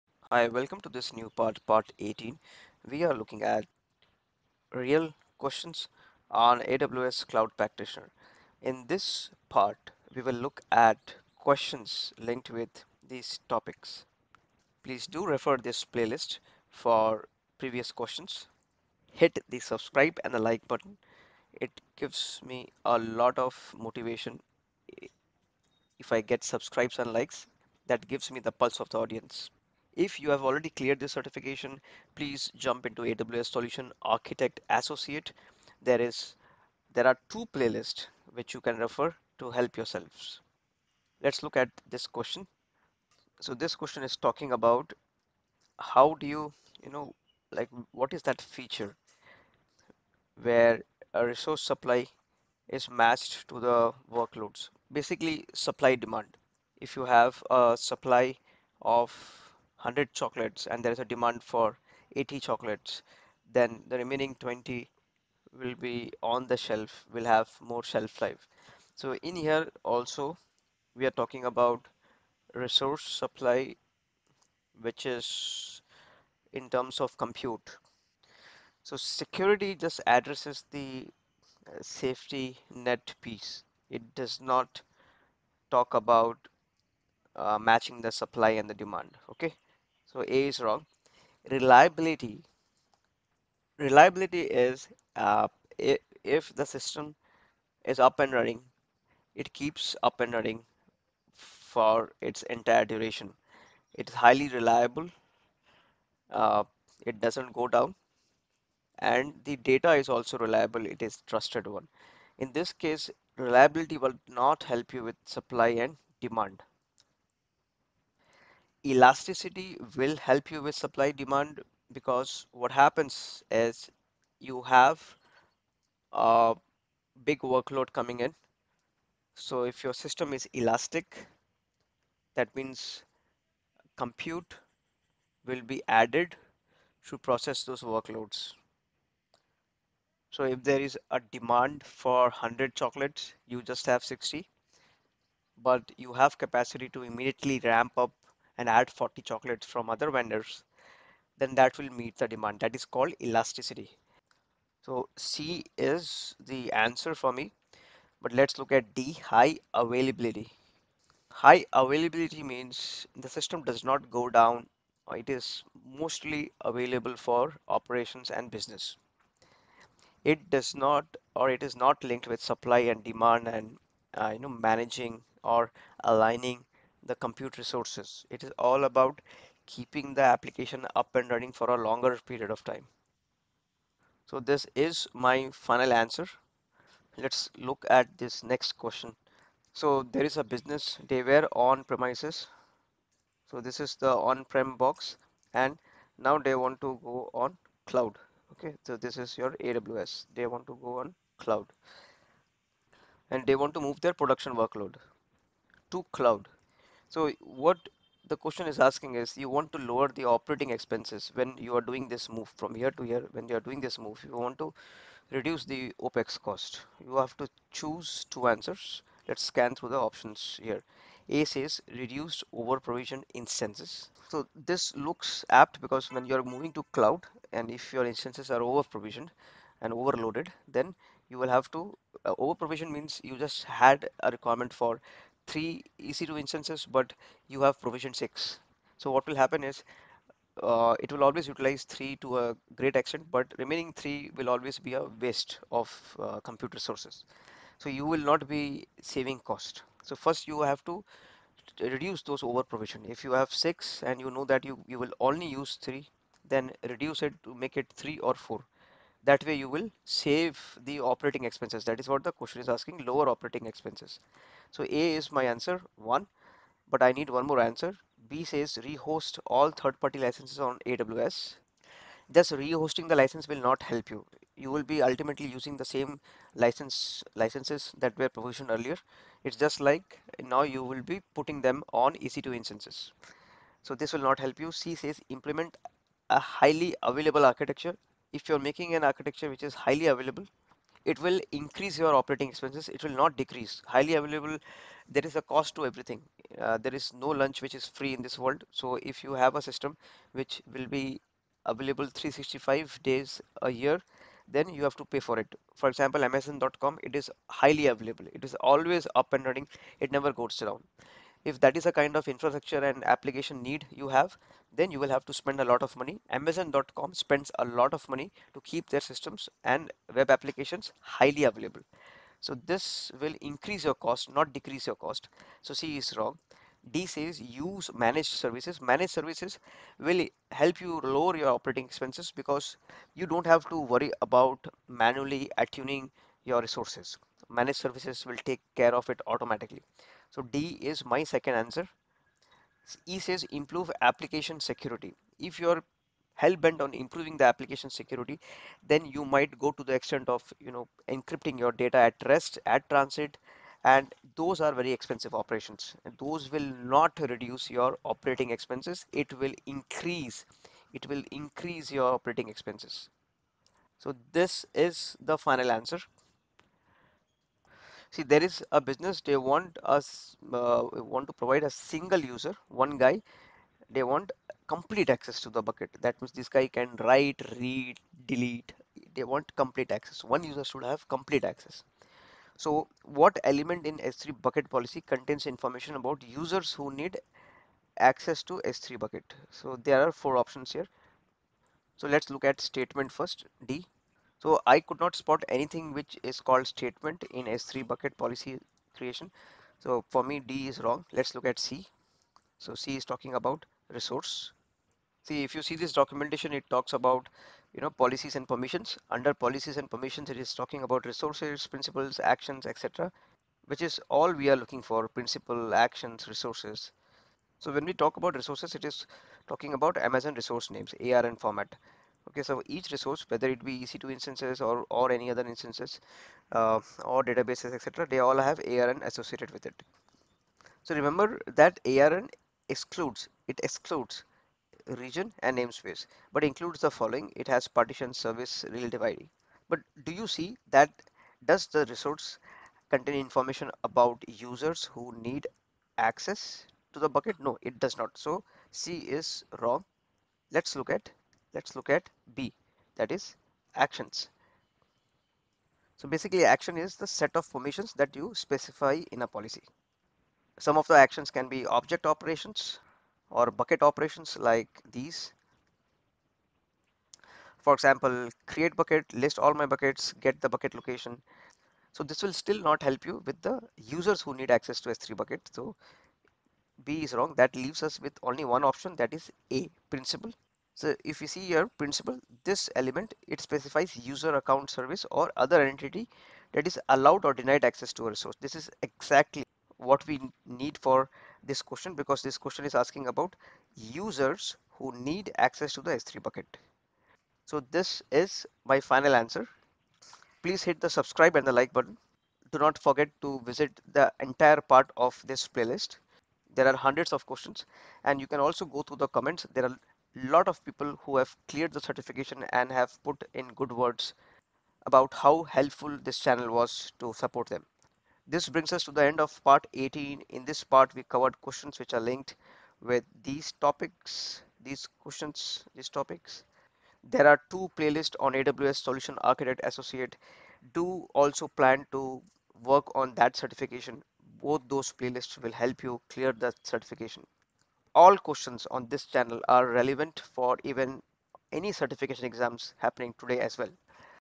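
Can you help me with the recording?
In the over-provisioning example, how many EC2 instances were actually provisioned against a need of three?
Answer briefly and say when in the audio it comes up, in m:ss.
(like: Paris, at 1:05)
6, at 3:57.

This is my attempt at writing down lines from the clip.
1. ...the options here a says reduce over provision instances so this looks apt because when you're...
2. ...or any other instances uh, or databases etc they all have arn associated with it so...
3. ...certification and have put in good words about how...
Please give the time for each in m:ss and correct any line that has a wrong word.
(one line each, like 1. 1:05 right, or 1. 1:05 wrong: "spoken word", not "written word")
1. 3:39 right
2. 7:04 right
3. 8:31 right.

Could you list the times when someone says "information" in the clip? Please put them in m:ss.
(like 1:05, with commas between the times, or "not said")
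6:25, 7:23.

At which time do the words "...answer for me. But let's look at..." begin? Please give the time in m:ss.
2:36.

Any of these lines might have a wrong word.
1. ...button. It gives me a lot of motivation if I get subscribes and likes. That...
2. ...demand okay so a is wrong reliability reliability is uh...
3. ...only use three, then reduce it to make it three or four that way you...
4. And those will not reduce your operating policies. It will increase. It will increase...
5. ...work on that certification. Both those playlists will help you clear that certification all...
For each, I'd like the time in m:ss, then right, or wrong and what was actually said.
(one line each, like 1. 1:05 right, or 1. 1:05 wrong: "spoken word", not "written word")
1. 0:20 right
2. 1:28 right
3. 4:15 right
4. 5:56 wrong: "expenses", not "policies"
5. 8:52 right.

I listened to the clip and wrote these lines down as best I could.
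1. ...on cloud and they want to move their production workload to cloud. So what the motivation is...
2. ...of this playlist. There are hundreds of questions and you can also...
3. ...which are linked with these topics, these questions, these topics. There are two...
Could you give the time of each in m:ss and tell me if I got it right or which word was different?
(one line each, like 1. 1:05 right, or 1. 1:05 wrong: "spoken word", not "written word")
1. 3:20 wrong: "question", not "motivation"
2. 8:24 right
3. 8:41 right.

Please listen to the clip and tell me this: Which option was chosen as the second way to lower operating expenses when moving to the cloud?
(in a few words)
Use managed services.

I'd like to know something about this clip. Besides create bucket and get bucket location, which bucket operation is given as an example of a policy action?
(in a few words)
List all my buckets.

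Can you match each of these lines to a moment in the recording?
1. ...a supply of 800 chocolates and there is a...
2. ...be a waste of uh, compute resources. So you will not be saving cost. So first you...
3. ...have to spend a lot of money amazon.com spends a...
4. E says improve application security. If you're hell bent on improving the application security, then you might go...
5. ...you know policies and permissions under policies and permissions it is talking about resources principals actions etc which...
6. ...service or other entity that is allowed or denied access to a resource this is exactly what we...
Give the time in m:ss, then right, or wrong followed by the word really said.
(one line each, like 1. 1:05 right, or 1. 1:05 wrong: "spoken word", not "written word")
1. 0:57 wrong: "100", not "800"
2. 4:04 right
3. 5:15 right
4. 5:43 right
5. 6:47 right
6. 8:04 right.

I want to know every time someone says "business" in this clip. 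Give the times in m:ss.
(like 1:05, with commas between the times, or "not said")
2:48, 3:10, 6:08.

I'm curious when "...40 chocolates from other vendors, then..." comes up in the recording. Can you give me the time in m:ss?
2:28.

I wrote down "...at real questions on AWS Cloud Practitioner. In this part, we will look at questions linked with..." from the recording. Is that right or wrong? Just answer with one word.
right.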